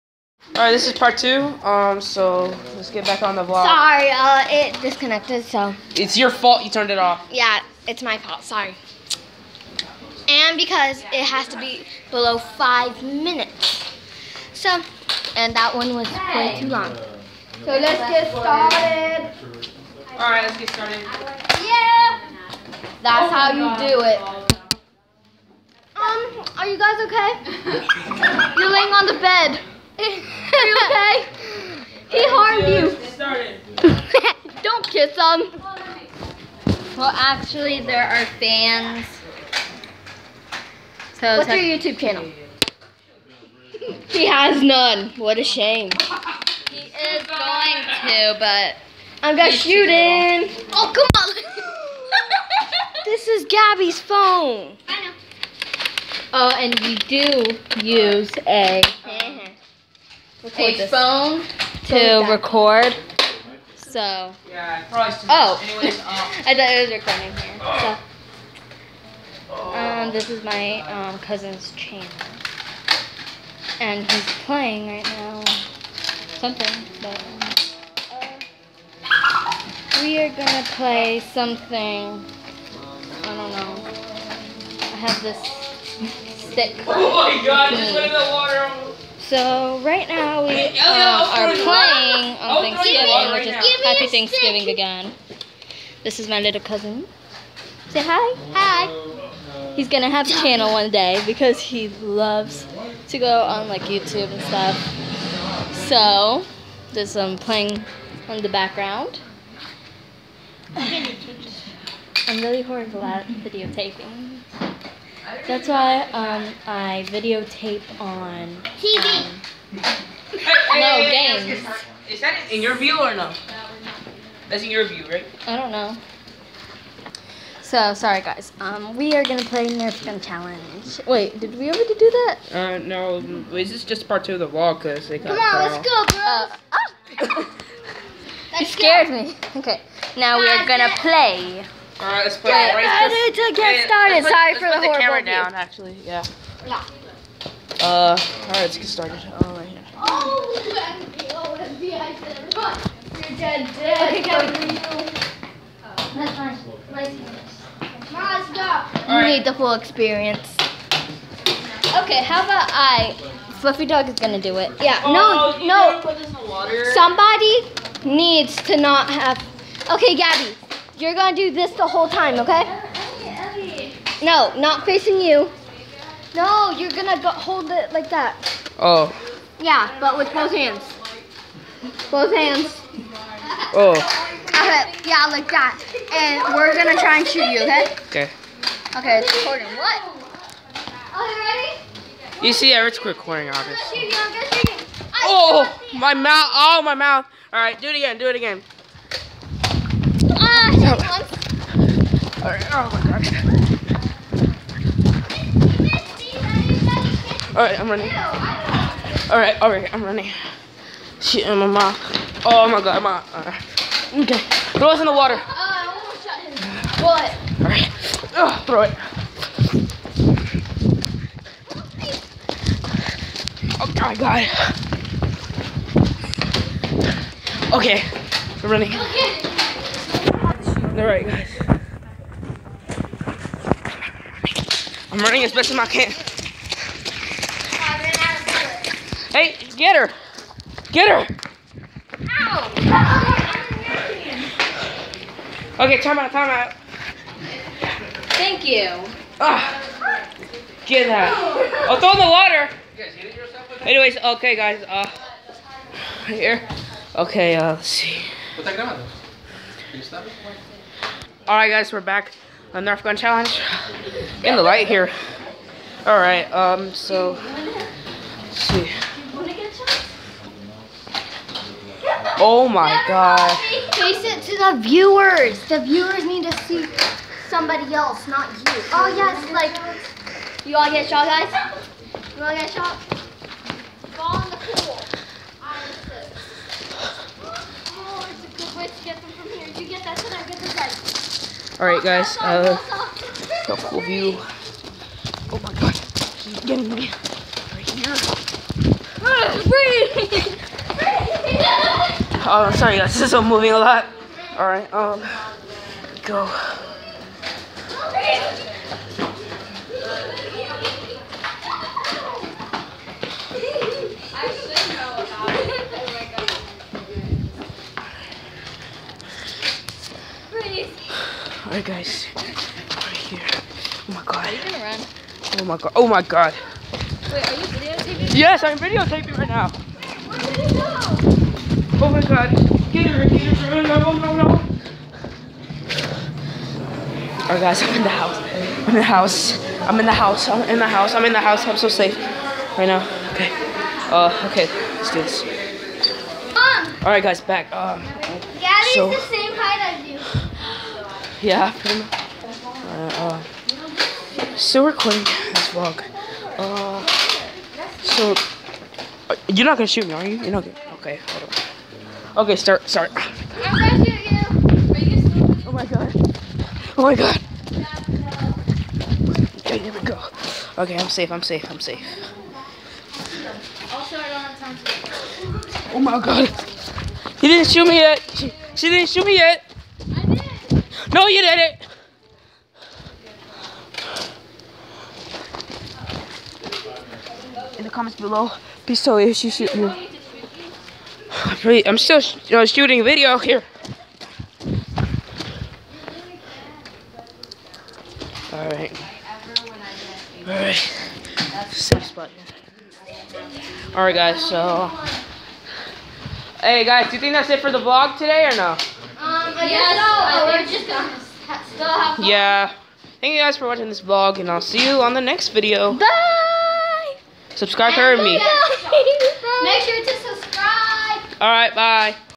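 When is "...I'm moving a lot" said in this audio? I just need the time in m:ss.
5:03.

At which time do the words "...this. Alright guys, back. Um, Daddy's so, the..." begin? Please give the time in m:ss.
5:45.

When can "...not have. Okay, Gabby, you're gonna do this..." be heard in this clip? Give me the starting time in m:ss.
2:48.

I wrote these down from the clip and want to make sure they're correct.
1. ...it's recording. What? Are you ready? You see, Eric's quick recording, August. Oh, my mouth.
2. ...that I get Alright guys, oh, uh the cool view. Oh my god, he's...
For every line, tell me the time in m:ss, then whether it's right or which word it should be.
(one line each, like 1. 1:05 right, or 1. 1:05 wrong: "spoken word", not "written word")
1. 3:09 right
2. 4:50 right.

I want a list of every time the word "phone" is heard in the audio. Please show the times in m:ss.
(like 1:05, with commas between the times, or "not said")
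0:53, 1:00.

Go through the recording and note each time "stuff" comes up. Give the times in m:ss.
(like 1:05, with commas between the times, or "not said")
1:44.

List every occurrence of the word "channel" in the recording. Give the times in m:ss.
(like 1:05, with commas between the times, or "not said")
0:41, 1:11, 1:40.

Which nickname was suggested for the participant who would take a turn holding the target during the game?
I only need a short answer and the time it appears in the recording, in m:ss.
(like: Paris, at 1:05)
Fluffy Dog, at 2:43.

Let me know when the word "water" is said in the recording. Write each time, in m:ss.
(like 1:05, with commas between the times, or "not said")
1:28, 3:35, 4:12.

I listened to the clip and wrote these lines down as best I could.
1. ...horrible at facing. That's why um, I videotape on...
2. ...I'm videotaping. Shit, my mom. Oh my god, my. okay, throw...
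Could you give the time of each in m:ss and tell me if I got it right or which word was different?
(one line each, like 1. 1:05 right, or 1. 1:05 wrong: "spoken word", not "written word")
1. 1:52 wrong: "videotaping", not "facing"
2. 3:29 wrong: "running", not "videotaping".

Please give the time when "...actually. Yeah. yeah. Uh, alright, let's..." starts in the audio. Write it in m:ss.
2:25.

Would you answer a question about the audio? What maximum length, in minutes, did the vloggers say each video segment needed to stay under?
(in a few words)
5.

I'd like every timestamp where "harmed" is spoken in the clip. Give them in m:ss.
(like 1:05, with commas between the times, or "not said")
0:32.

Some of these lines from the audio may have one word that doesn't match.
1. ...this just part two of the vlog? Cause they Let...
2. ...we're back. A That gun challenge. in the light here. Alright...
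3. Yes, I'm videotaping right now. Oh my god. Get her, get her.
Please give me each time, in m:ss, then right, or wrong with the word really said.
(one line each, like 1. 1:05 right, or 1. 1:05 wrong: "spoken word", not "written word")
1. 2:13 wrong: "Come", not "Let"
2. 4:21 wrong: "Nerf", not "That"
3. 5:28 right.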